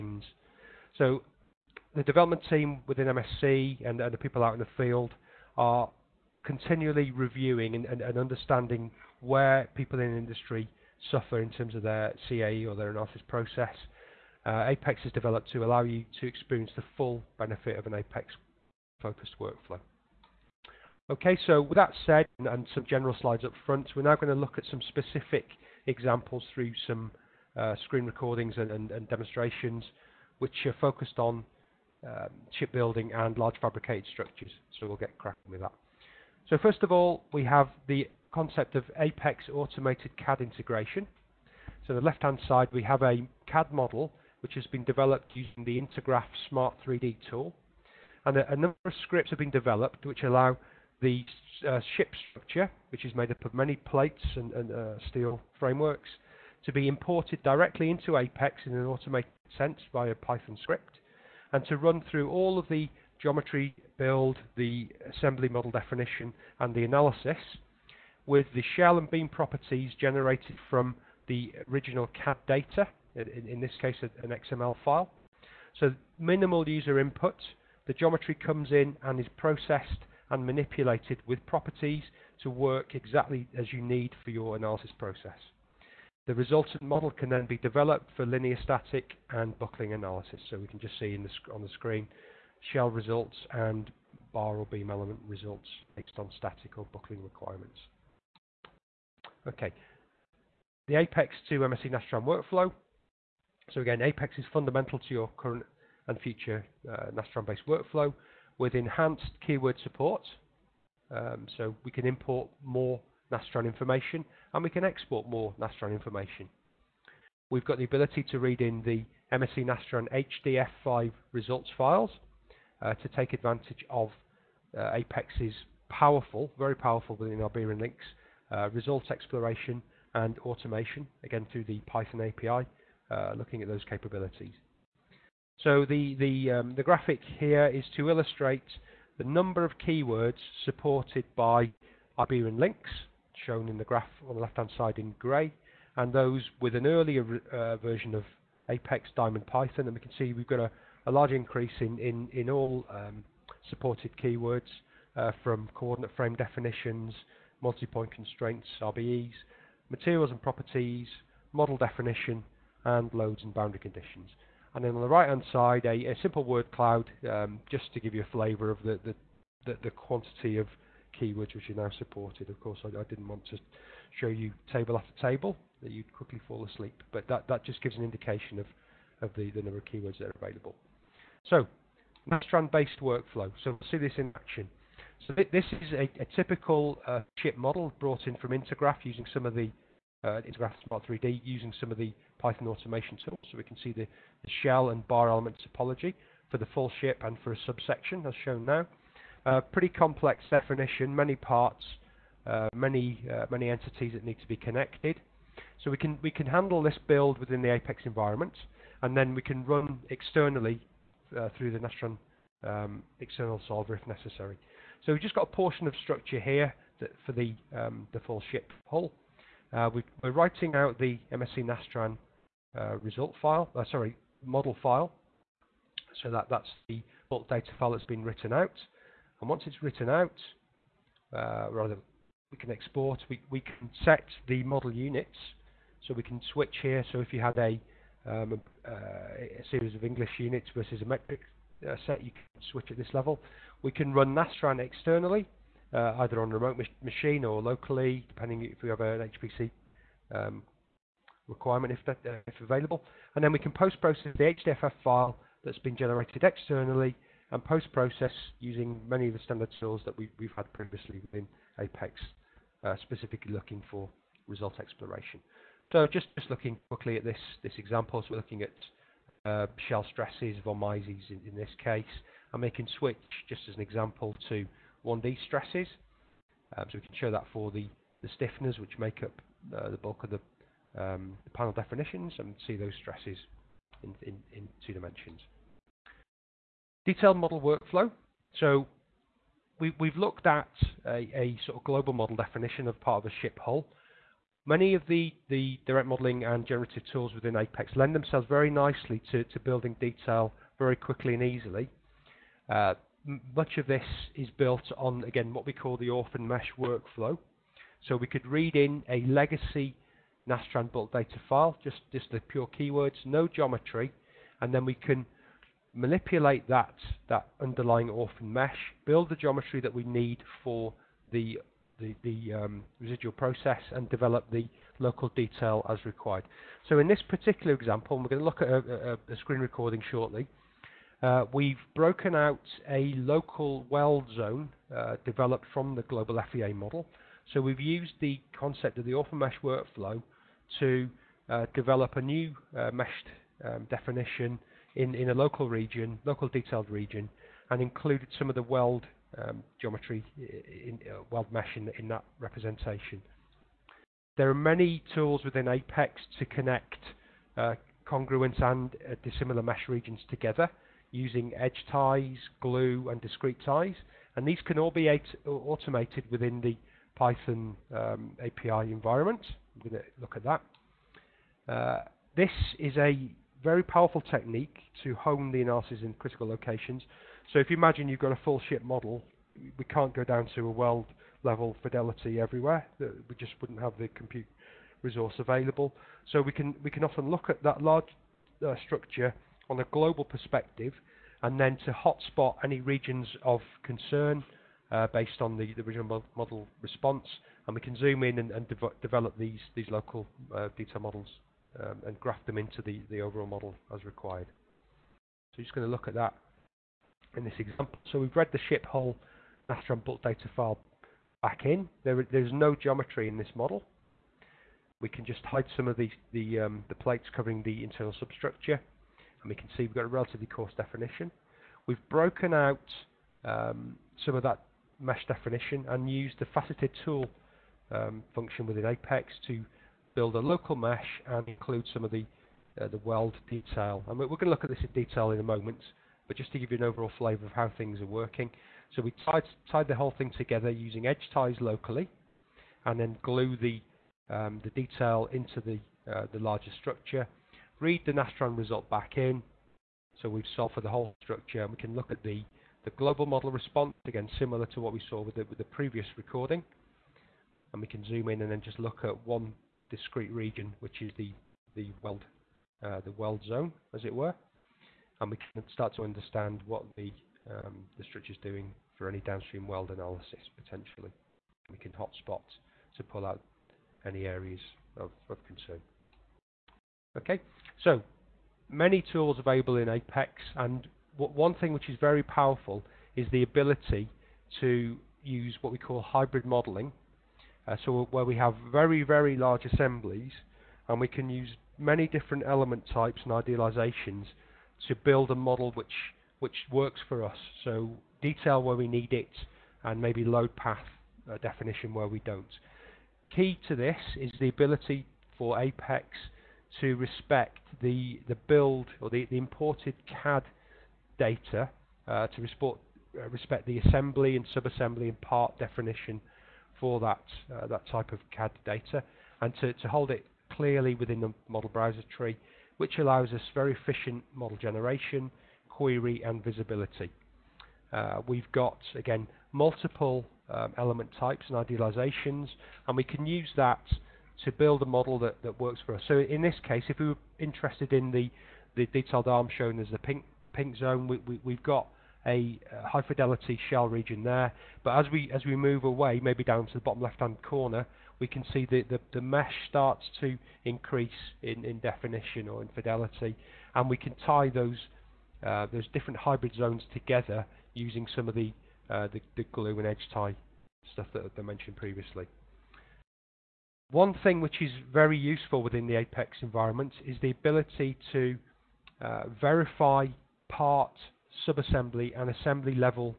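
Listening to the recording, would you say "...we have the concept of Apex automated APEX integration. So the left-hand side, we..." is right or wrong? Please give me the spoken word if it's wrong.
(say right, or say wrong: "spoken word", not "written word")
wrong: "CAD", not "APEX".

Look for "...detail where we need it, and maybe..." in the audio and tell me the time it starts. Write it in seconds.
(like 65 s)
498 s.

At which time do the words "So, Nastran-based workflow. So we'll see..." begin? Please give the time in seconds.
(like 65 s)
181 s.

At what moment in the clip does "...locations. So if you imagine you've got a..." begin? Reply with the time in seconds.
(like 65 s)
376 s.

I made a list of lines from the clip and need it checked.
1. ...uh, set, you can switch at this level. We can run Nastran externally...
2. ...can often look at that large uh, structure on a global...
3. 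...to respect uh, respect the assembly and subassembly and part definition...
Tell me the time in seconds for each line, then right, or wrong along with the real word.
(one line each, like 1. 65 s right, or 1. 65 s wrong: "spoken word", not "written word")
1. 241 s right
2. 386 s right
3. 512 s right.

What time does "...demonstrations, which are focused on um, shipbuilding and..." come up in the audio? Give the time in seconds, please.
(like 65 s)
29 s.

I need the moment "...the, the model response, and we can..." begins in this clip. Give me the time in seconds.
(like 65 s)
395 s.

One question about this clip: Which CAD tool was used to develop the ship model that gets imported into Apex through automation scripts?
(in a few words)
Intergraph Smart 3D.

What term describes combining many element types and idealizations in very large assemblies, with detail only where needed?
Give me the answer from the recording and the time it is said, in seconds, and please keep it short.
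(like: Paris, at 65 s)
Hybrid modeling, at 485 s.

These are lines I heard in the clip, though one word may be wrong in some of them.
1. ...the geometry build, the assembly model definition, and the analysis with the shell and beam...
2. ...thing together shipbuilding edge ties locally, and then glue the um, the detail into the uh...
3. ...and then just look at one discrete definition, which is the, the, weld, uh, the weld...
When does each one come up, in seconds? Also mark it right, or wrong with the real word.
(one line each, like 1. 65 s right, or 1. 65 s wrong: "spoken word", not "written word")
1. 62 s right
2. 440 s wrong: "using", not "shipbuilding"
3. 458 s wrong: "region", not "definition".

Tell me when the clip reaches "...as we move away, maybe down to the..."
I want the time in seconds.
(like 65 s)
545 s.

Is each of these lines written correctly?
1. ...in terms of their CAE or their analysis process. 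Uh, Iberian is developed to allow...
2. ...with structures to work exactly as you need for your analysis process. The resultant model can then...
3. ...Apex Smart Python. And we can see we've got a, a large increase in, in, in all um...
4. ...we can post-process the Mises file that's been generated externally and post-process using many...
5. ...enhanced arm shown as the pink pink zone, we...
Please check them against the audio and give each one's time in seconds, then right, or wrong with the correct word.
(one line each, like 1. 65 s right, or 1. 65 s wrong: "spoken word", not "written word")
1. 11 s wrong: "Apex", not "Iberian"
2. 81 s wrong: "properties", not "structures"
3. 148 s wrong: "Diamond", not "Smart"
4. 253 s wrong: "HDFF", not "Mises"
5. 538 s wrong: "detailed", not "enhanced".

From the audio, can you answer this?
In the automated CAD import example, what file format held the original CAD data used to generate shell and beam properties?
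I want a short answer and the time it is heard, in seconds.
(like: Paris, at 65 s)
XML, at 74 s.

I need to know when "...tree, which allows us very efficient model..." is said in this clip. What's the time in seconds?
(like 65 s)
522 s.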